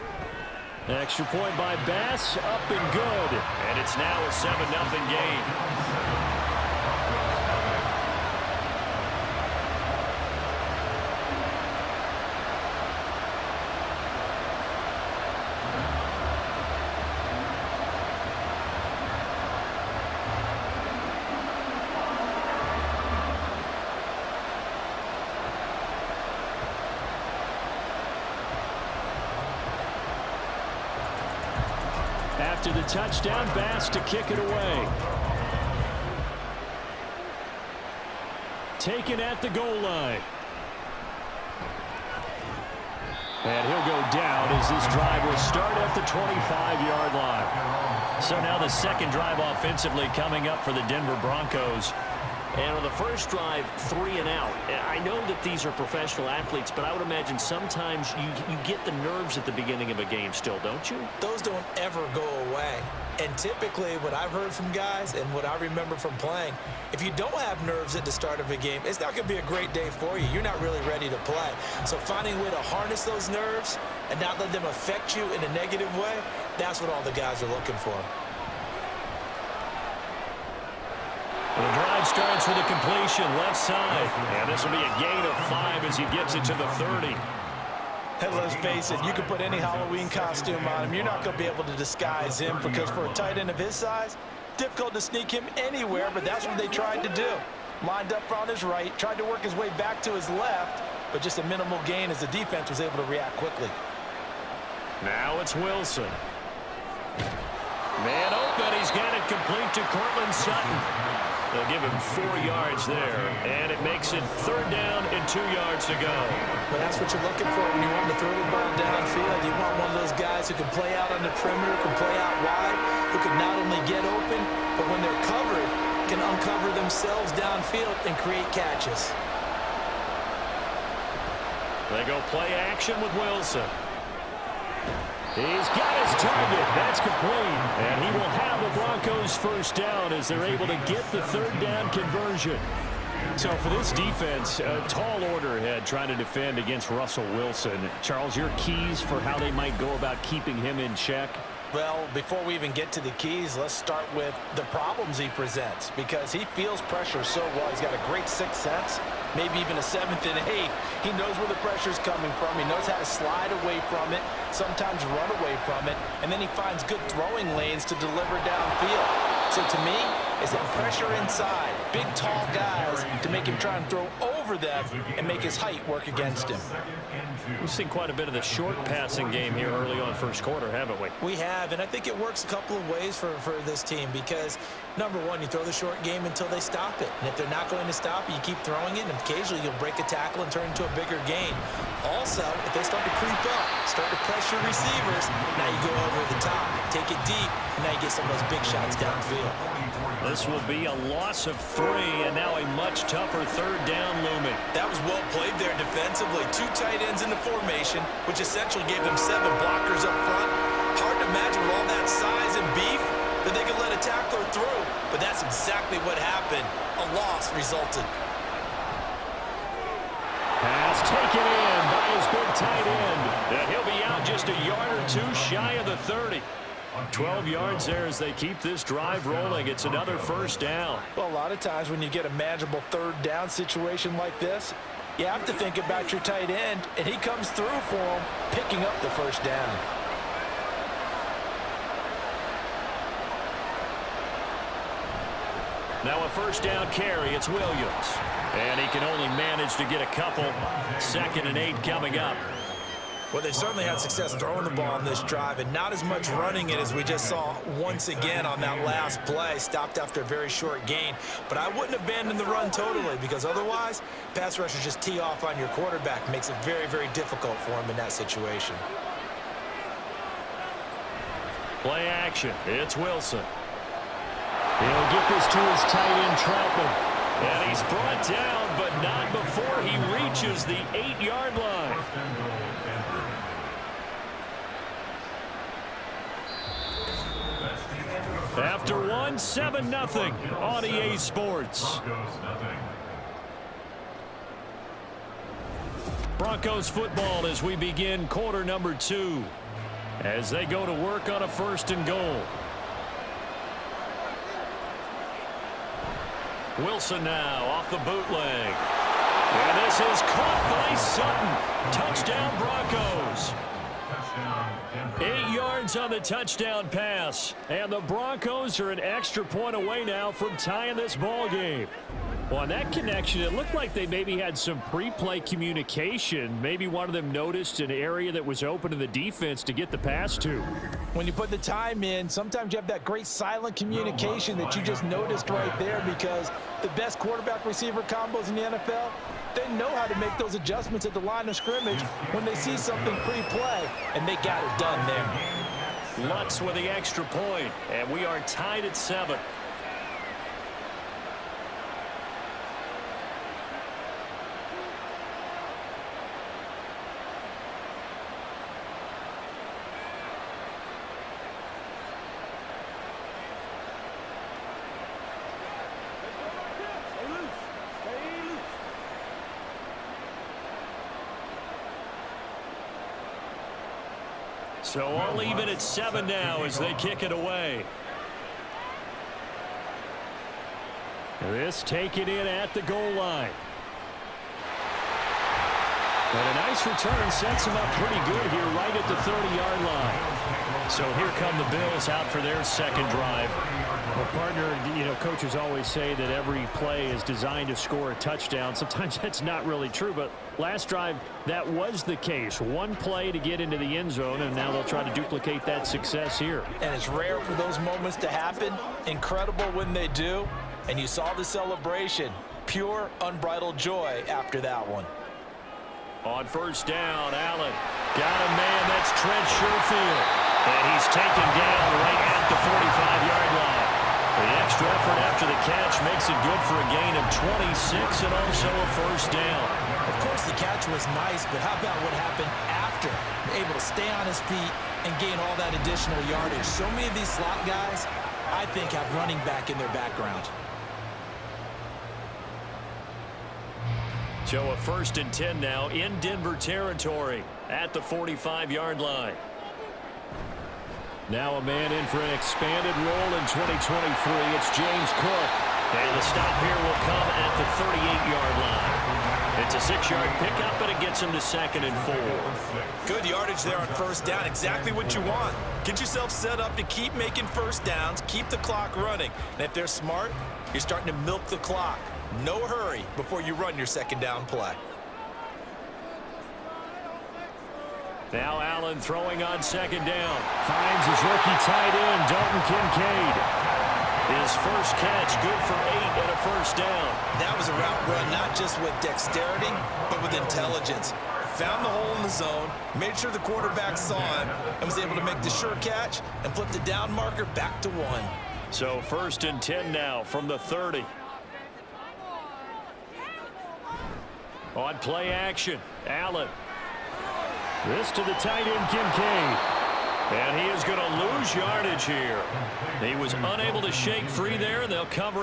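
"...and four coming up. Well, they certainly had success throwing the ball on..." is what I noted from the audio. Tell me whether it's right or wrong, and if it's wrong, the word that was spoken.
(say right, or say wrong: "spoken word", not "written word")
wrong: "eight", not "four".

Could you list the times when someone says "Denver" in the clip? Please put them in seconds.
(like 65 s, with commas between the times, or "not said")
50 s, 446 s.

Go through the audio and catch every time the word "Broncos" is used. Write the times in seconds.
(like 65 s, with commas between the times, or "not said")
51 s, 138 s, 296 s, 312 s, 318 s.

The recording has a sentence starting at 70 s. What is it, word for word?
You're not really ready to play.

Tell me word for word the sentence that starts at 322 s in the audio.
Well, on that connection, it looked like they maybe had some pre-play communication.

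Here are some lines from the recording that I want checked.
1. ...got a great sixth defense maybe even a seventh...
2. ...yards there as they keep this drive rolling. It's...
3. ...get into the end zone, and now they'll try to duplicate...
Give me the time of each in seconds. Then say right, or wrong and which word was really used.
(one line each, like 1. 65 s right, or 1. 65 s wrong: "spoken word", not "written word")
1. 157 s wrong: "sense", not "defense"
2. 227 s right
3. 403 s right.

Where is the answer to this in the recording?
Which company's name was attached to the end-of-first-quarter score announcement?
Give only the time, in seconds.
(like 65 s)
290 s.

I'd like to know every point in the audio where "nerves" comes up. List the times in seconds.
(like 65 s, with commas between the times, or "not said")
58 s, 67 s, 73 s.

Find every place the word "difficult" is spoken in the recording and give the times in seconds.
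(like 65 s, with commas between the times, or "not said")
94 s, 267 s.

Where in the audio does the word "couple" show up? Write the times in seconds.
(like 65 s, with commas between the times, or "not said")
182 s, 250 s.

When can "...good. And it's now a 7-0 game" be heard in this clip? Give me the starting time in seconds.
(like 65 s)
2 s.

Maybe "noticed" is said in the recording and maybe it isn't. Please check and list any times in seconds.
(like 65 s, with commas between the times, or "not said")
327 s, 335 s.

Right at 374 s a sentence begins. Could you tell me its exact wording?
So i will leave it at seven now as they kick it away.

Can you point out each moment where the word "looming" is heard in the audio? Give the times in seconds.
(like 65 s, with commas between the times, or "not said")
204 s.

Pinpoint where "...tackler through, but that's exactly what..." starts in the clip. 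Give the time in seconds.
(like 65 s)
214 s.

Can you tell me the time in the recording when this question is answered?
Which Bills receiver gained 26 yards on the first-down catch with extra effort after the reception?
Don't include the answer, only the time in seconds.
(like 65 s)
419 s.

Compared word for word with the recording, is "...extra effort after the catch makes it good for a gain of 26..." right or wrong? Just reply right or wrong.
right.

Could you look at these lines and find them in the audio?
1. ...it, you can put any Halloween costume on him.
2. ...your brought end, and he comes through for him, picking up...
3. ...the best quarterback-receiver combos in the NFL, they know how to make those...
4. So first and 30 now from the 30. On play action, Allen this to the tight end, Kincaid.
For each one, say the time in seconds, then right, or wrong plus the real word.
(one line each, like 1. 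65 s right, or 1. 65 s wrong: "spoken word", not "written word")
1. 88 s right
2. 236 s wrong: "tight", not "brought"
3. 336 s right
4. 498 s wrong: "10", not "30".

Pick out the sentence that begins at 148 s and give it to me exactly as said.
Charles, your keys for how they might go about keeping him in check?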